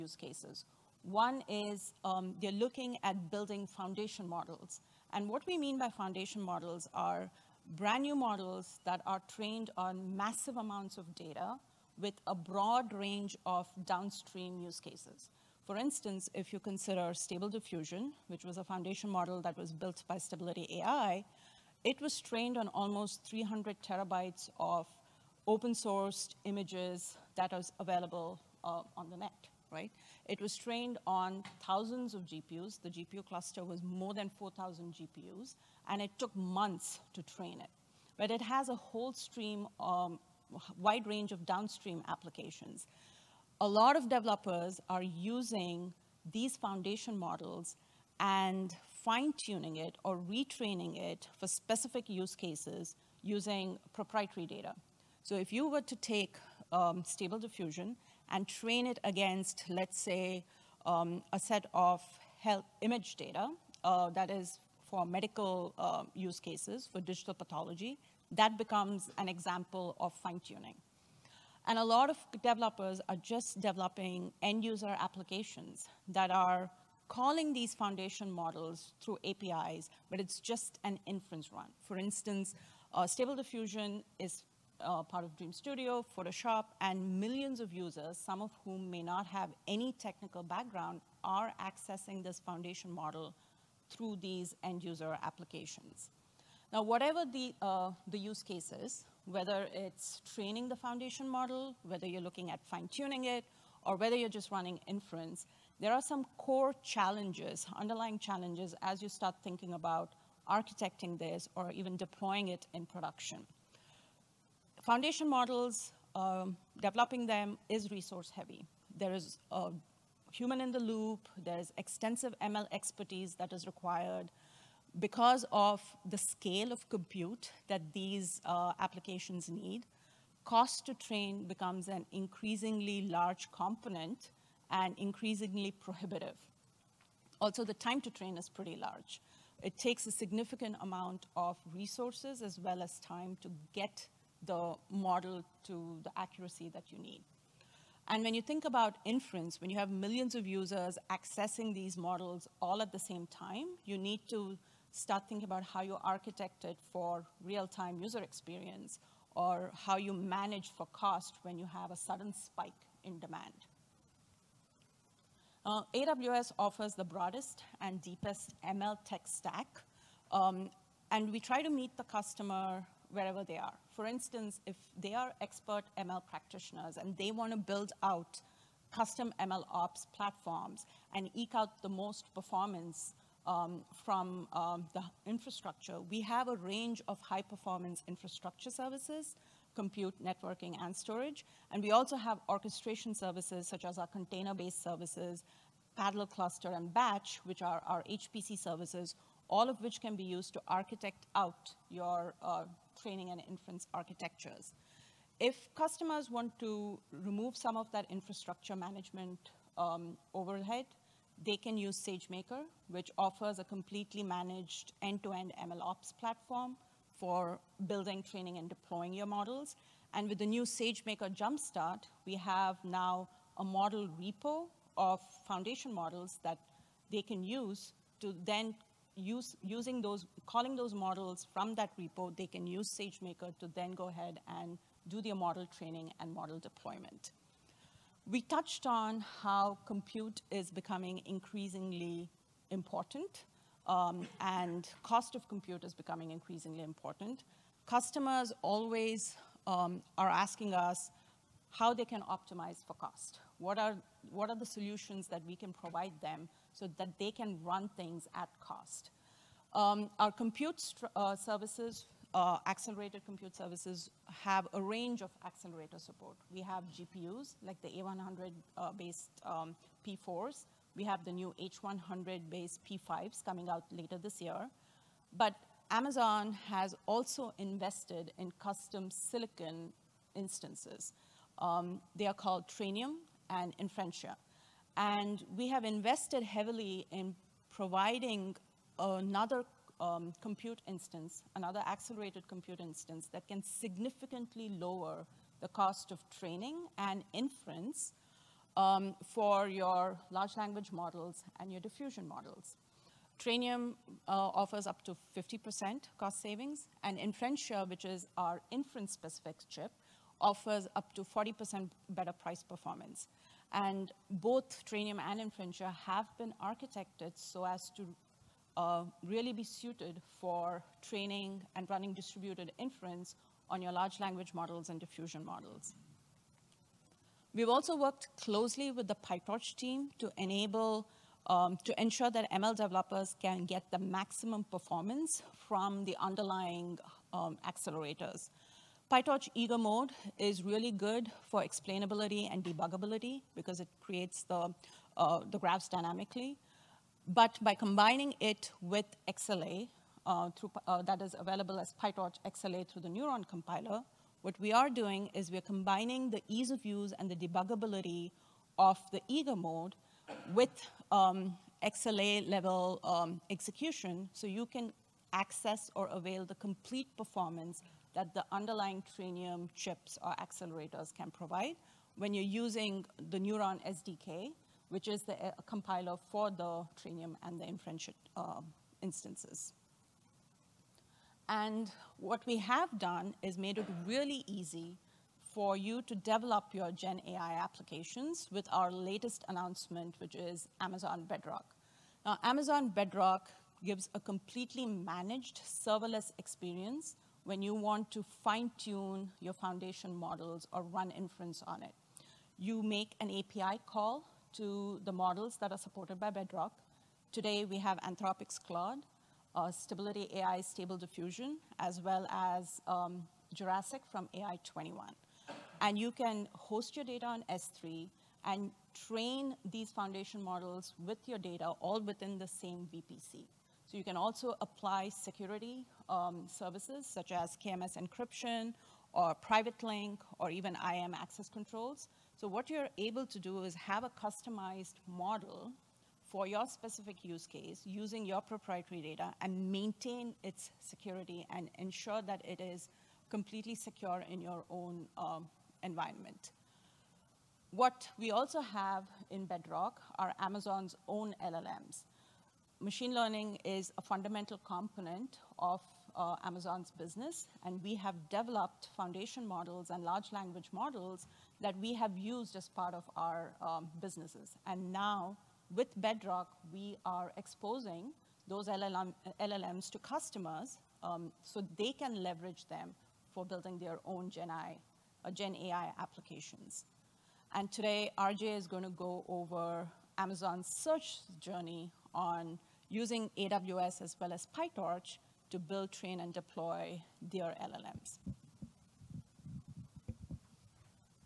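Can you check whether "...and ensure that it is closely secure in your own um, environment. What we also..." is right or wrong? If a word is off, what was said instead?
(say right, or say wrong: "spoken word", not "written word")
wrong: "completely", not "closely".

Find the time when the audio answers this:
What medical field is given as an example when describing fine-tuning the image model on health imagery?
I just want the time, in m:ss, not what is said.
1:07.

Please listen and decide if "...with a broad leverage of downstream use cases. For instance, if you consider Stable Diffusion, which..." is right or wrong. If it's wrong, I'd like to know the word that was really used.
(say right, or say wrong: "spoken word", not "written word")
wrong: "range", not "leverage".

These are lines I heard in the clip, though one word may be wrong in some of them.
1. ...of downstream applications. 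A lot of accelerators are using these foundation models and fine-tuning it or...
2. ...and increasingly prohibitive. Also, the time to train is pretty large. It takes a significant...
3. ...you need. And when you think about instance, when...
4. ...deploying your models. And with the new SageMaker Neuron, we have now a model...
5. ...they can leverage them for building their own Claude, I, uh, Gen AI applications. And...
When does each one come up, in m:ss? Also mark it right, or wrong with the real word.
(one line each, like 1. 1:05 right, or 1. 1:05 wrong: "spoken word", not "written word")
1. 0:41 wrong: "developers", not "accelerators"
2. 2:14 right
3. 2:26 wrong: "inference", not "instance"
4. 3:38 wrong: "Jumpstart", not "Neuron"
5. 7:51 wrong: "Gen", not "Claude".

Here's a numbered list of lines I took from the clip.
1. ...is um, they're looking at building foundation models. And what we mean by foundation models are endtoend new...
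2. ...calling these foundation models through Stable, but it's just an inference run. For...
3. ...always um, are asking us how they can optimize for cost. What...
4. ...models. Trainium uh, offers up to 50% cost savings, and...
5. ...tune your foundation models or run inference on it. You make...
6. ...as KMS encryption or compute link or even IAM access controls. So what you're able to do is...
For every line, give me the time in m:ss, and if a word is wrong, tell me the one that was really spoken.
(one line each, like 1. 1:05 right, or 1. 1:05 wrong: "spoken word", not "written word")
1. 0:01 wrong: "brand", not "endtoend"
2. 1:17 wrong: "APIs", not "Stable"
3. 4:08 right
4. 5:02 right
5. 6:38 right
6. 7:07 wrong: "private", not "compute".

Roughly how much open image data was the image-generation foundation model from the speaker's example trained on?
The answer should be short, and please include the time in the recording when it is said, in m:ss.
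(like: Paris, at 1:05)
300 terabytes, at 0:23.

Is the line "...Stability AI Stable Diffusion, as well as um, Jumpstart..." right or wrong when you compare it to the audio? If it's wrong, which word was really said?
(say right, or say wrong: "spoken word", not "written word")
wrong: "Jurassic", not "Jumpstart".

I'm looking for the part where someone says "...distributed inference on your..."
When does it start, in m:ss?
5:22.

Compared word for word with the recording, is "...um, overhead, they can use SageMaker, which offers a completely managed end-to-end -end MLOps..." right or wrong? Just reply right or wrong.
right.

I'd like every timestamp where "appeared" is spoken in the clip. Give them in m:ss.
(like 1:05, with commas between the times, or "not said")
not said.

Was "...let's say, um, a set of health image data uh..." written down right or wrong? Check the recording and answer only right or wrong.
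right.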